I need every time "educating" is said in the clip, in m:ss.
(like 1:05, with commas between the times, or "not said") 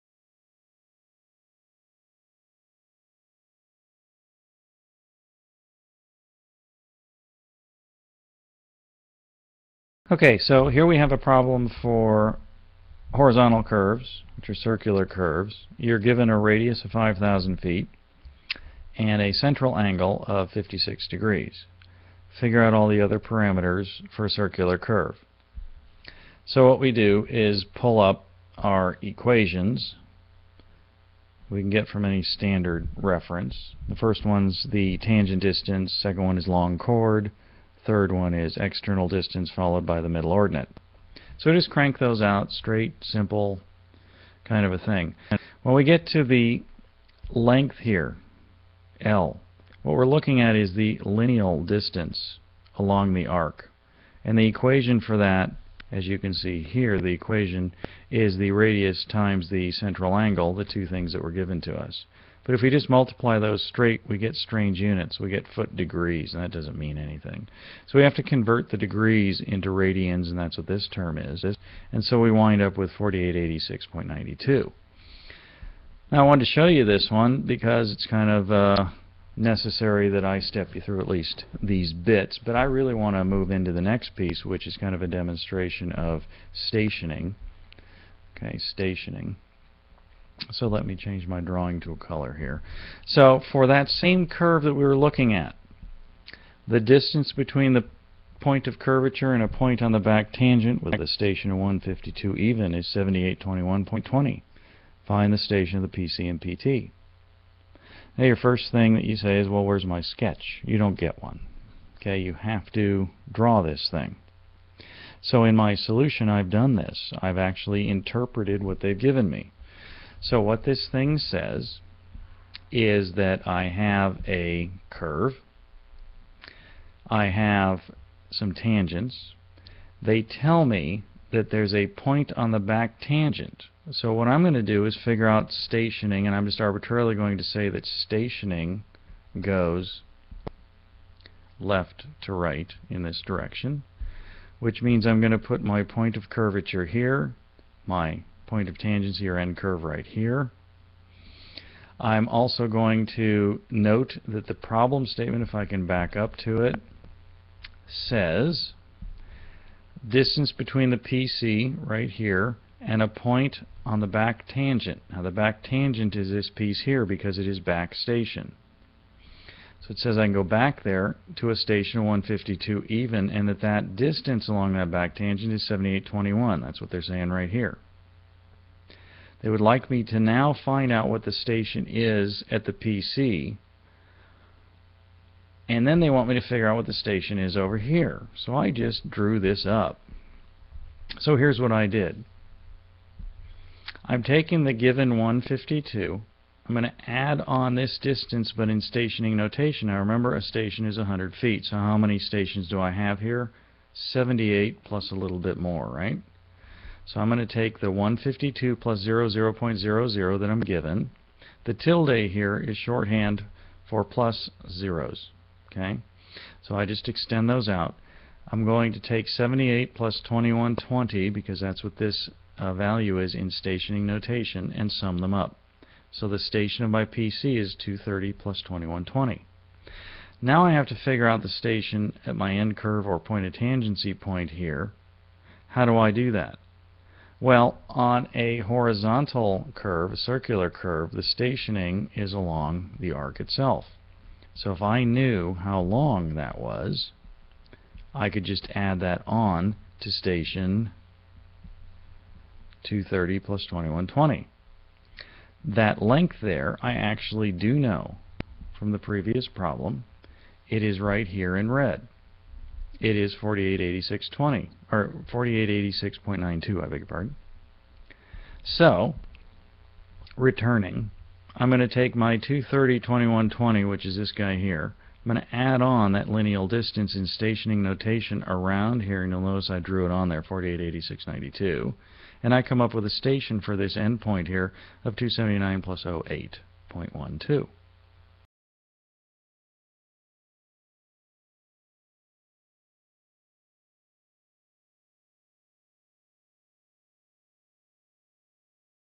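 not said.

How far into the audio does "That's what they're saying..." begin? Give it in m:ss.
2:56.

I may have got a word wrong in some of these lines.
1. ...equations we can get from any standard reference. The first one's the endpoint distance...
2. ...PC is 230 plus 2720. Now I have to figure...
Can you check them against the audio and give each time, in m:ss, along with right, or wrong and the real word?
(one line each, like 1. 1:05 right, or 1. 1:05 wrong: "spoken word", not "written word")
1. 0:29 wrong: "tangent", not "endpoint"
2. 3:47 wrong: "2120", not "2720".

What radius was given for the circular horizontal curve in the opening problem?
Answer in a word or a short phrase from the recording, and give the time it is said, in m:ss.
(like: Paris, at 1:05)
5,000 feet, at 0:16.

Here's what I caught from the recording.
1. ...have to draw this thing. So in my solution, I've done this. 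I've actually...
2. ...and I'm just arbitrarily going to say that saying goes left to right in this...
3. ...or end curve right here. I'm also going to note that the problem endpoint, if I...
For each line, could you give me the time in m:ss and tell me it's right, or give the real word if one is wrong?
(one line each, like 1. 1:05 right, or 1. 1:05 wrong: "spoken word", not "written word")
1. 1:52 right
2. 2:16 wrong: "stationing", not "saying"
3. 2:29 wrong: "statement", not "endpoint".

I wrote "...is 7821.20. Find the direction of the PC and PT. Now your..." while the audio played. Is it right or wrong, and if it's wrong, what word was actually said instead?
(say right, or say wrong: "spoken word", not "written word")
wrong: "station", not "direction".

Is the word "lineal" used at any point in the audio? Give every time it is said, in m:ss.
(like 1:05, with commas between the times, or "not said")
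0:50, 4:36.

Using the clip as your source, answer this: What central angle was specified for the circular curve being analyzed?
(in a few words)
56 degrees.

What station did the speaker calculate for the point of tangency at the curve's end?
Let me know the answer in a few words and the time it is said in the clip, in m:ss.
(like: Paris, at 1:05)
279+08.12, at 4:45.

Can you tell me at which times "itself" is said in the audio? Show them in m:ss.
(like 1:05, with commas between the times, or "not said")
4:03.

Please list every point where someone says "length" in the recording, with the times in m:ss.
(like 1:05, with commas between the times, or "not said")
0:47, 4:15.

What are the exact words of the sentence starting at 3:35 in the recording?
Okay, So I just extend those out.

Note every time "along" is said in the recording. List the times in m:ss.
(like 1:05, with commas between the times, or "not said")
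0:52, 2:54, 4:02.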